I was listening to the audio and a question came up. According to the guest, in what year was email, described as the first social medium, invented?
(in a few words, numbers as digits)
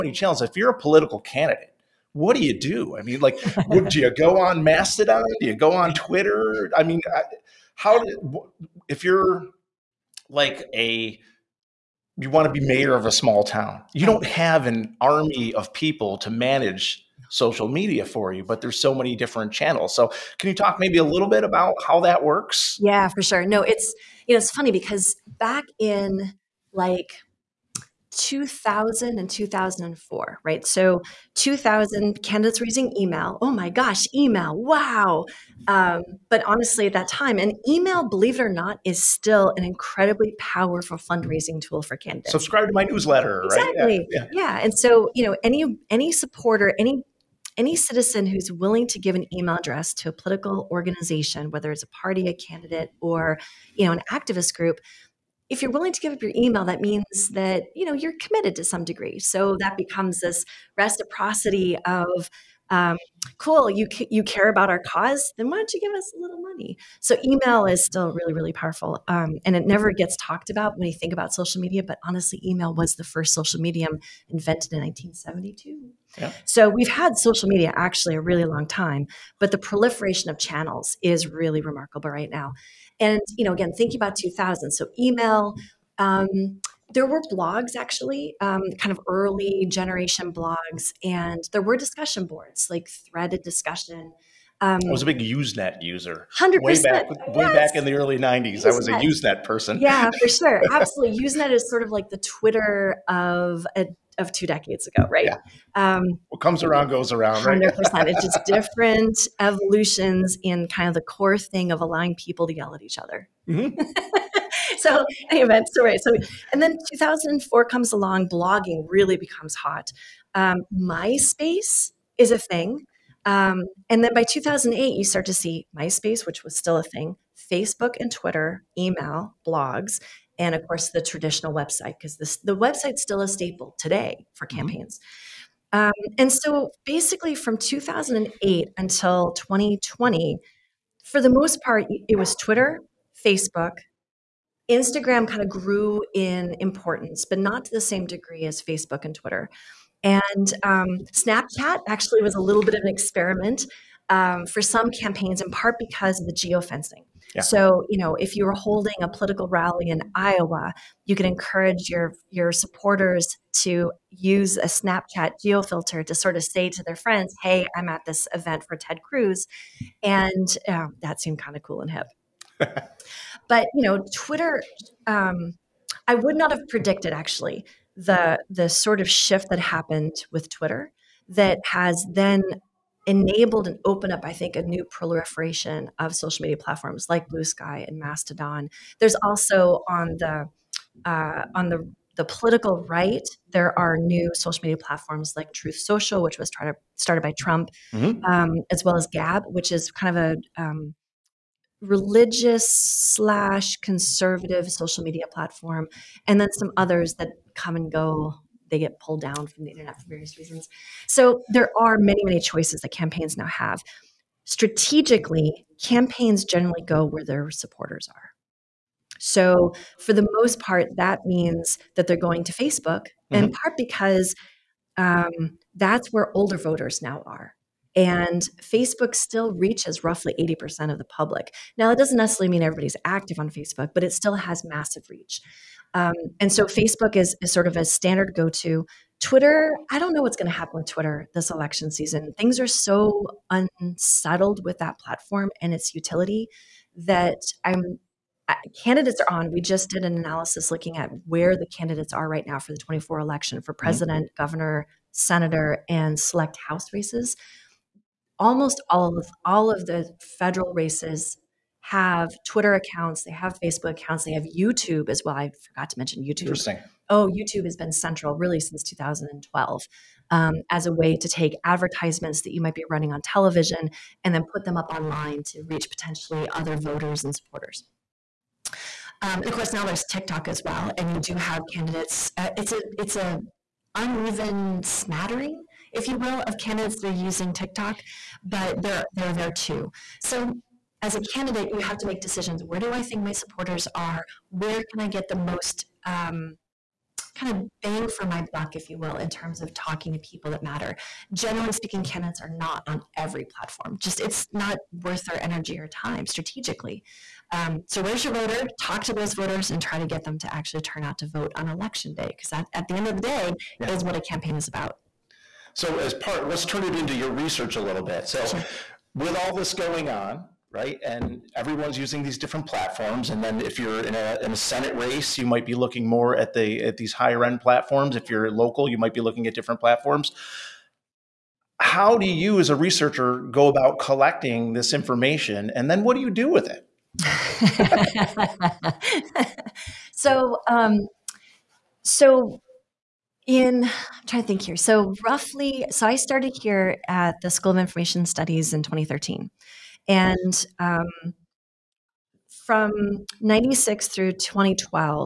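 1972.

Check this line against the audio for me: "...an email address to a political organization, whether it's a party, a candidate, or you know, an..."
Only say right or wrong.
right.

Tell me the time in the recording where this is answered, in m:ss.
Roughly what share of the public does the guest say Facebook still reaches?
3:50.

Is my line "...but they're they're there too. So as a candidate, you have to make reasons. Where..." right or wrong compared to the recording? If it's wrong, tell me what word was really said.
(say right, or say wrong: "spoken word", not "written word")
wrong: "decisions", not "reasons".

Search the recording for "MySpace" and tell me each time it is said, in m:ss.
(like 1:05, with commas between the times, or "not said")
2:00, 2:05.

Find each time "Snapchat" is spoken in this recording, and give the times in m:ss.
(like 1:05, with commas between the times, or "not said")
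2:31, 2:44.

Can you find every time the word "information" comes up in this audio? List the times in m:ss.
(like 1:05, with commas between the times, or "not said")
5:34, 5:47.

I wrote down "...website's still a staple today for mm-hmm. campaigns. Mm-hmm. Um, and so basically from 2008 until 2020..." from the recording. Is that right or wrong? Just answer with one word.
right.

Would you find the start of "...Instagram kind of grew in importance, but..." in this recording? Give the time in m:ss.
2:24.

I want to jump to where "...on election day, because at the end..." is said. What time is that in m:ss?
5:11.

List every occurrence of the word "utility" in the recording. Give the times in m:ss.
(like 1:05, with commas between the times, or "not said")
4:05.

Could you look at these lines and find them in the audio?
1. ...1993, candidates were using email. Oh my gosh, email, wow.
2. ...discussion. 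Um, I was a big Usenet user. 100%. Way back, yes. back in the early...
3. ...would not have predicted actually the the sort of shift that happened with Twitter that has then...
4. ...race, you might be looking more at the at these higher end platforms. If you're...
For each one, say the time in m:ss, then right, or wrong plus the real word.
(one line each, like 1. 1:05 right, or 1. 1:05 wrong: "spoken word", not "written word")
1. 0:31 wrong: "2000", not "1993"
2. 1:33 right
3. 2:56 right
4. 5:24 right.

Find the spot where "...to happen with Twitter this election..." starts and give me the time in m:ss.
4:00.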